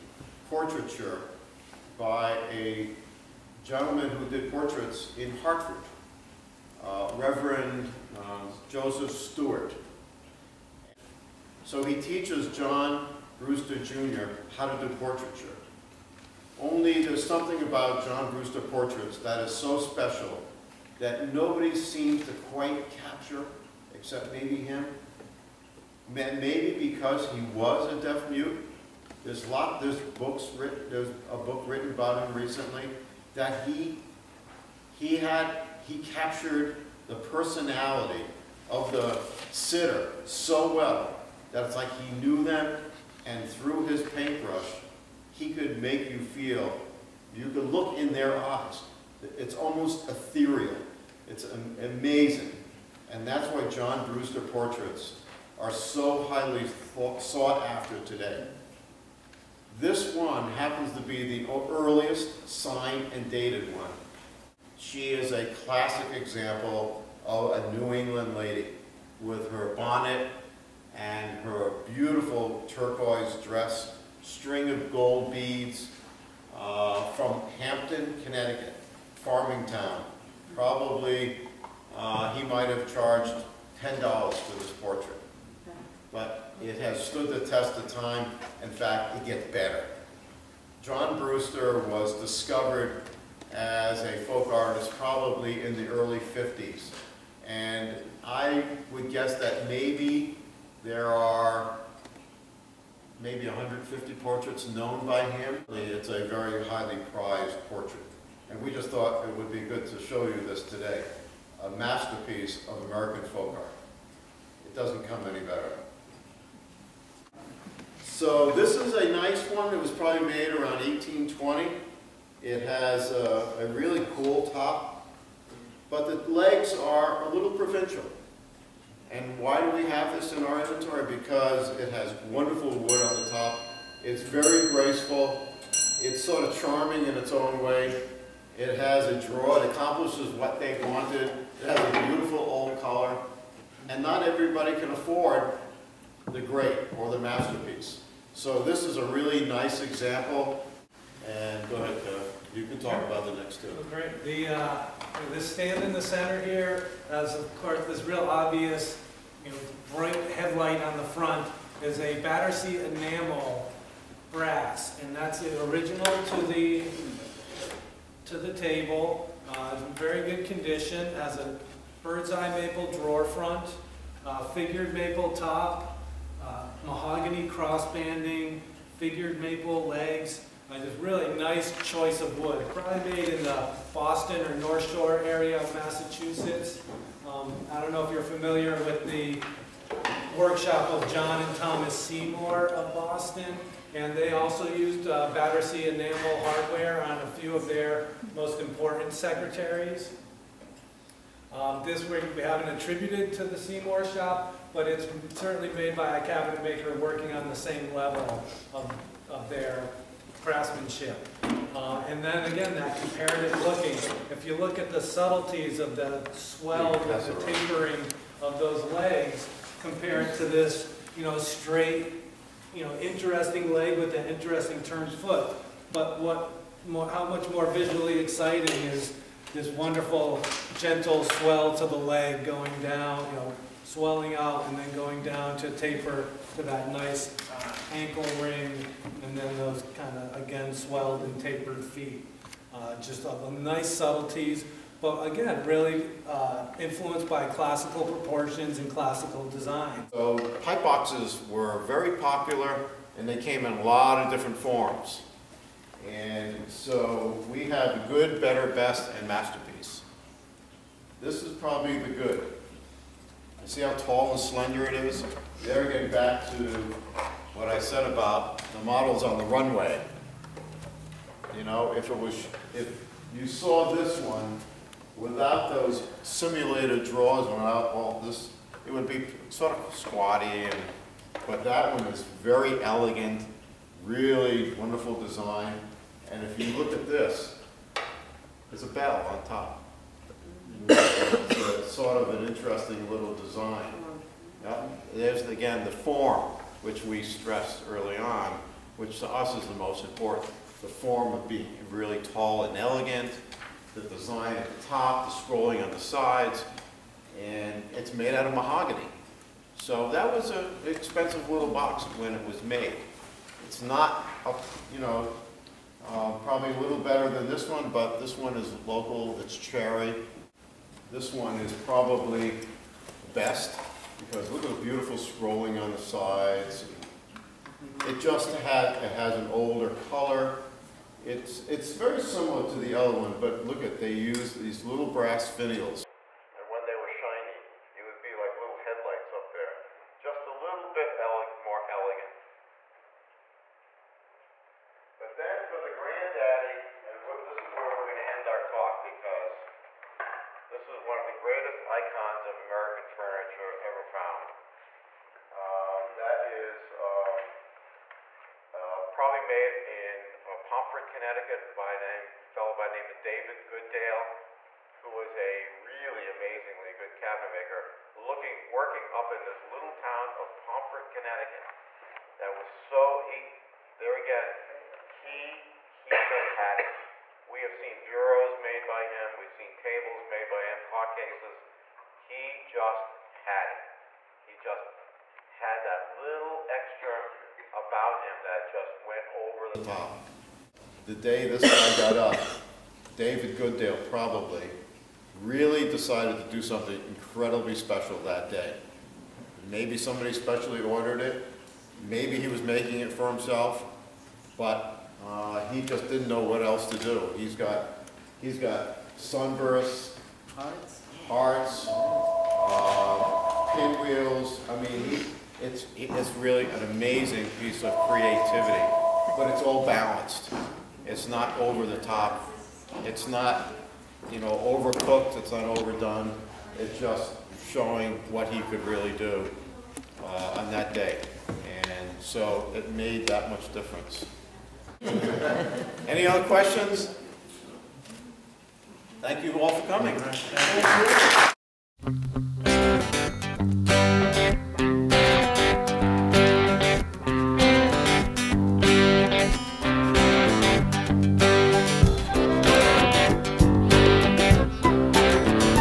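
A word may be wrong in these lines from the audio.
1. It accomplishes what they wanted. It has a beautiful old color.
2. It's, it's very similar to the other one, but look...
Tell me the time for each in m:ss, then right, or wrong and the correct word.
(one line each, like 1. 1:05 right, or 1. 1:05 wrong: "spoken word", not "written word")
1. 2:19 right
2. 5:31 right.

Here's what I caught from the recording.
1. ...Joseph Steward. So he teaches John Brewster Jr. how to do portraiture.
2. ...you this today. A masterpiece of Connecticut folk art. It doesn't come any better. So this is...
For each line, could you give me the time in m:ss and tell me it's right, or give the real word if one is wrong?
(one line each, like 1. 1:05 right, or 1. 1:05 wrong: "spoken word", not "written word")
1. 0:08 right
2. 1:50 wrong: "American", not "Connecticut".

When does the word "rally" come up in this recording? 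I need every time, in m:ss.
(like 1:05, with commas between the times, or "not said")
not said.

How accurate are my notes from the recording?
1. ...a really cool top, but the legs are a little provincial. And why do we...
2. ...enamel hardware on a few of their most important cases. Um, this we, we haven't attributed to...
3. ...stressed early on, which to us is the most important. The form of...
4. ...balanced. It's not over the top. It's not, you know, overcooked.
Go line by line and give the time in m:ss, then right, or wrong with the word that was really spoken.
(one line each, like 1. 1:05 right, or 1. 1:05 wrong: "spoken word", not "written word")
1. 2:03 right
2. 3:15 wrong: "secretaries", not "cases"
3. 4:57 right
4. 6:59 right.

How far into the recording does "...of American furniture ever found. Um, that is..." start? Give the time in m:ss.
5:52.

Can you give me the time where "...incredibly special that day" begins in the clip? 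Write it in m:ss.
6:37.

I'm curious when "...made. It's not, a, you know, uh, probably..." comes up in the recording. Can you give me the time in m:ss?
5:12.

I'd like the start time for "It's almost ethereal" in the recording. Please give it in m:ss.
0:49.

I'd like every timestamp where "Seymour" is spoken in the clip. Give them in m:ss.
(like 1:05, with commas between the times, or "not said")
3:11, 3:23.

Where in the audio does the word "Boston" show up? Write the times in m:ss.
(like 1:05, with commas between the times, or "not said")
3:03, 3:12.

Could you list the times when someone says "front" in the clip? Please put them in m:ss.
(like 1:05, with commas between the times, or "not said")
2:41, 2:53.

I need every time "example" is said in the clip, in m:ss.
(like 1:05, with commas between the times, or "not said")
1:06, 2:29.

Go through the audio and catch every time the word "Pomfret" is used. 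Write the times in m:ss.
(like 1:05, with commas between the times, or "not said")
6:00, 6:10.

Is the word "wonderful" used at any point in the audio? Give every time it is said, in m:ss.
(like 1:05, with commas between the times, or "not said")
2:12, 3:49, 4:44.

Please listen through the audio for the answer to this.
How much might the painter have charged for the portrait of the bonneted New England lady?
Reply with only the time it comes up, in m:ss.
1:23.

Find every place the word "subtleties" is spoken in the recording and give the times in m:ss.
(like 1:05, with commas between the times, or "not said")
3:35, 4:03.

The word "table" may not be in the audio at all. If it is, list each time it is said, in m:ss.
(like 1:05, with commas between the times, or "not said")
2:48, 6:19.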